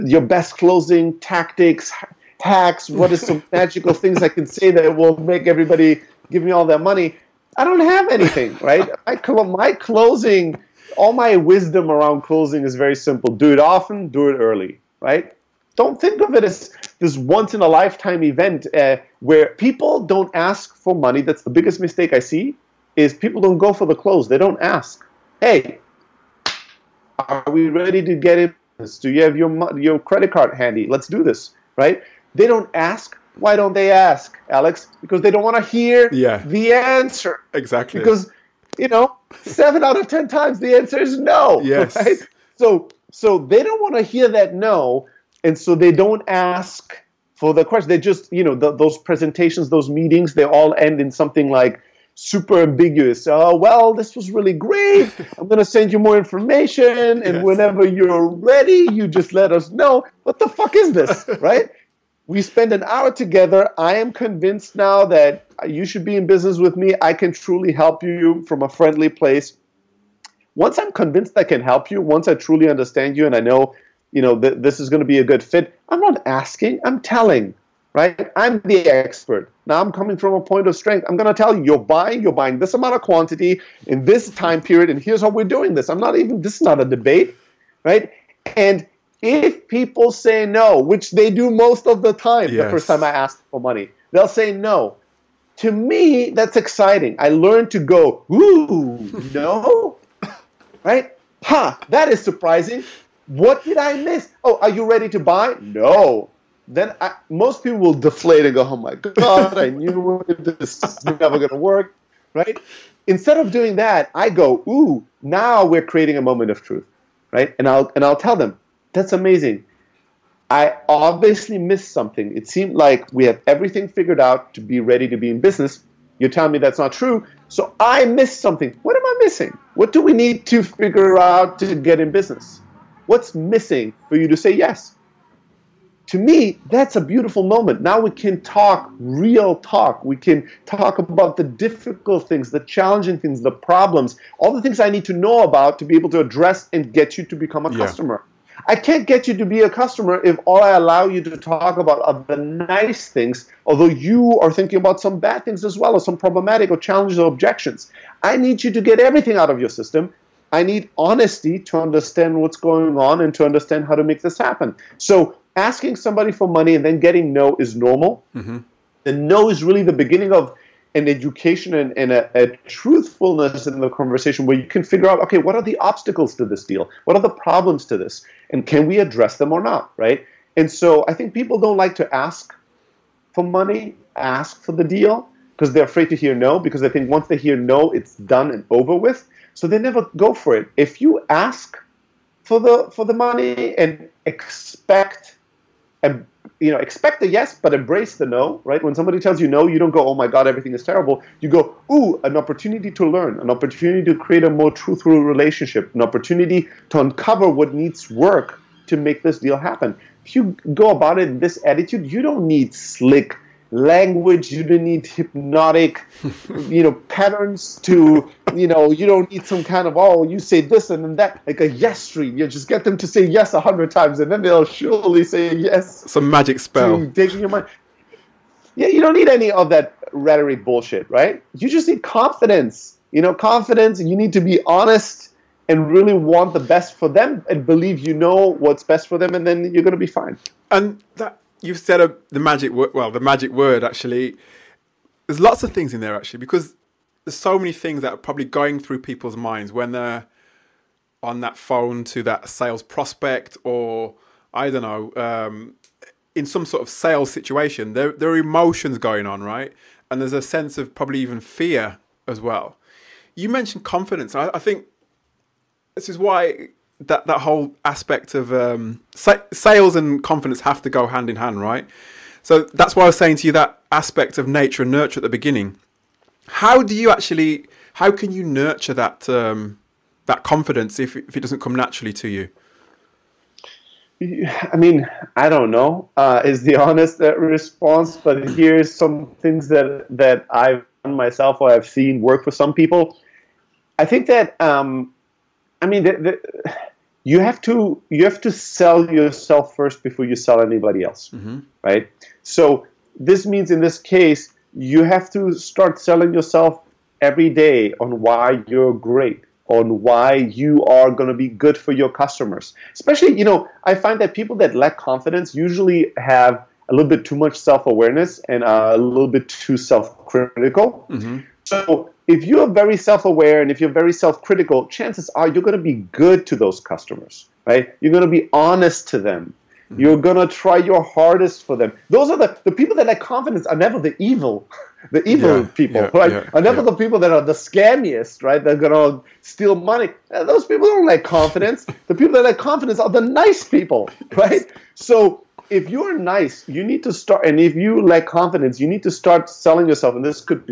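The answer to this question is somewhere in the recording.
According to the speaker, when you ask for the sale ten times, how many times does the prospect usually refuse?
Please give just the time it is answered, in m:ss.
0:39.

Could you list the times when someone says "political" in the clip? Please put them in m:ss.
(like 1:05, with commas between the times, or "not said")
not said.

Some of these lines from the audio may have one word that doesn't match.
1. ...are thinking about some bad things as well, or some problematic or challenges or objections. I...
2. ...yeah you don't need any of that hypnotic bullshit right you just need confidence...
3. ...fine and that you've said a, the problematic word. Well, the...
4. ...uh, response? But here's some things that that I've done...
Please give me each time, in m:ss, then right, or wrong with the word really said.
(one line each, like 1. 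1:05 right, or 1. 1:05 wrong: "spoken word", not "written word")
1. 2:34 right
2. 3:48 wrong: "rhetoric", not "hypnotic"
3. 4:00 wrong: "magic", not "problematic"
4. 4:47 right.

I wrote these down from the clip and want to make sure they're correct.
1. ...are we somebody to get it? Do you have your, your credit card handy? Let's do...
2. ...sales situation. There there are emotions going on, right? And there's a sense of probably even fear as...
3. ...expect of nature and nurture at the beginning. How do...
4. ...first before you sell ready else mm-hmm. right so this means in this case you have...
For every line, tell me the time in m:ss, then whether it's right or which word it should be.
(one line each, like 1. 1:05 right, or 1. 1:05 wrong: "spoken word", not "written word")
1. 0:27 wrong: "ready", not "somebody"
2. 4:16 right
3. 4:33 wrong: "aspect", not "expect"
4. 4:59 wrong: "anybody", not "ready".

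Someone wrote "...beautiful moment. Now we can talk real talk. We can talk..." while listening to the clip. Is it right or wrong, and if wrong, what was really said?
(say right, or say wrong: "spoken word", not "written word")
right.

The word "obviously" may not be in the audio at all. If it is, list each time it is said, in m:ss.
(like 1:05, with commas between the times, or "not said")
2:00.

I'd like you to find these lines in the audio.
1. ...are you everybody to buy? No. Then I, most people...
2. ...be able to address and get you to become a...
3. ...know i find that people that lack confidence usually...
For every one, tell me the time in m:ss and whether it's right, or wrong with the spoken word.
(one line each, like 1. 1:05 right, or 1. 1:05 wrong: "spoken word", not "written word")
1. 1:44 wrong: "ready", not "everybody"
2. 2:25 right
3. 5:13 right.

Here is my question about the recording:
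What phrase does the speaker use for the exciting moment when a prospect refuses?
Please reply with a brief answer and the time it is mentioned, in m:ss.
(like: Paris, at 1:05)
moment of truth, at 1:56.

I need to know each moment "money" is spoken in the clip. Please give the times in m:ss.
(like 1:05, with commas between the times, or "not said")
0:06, 0:20, 1:33, 2:46, 3:03, 3:13, 5:39.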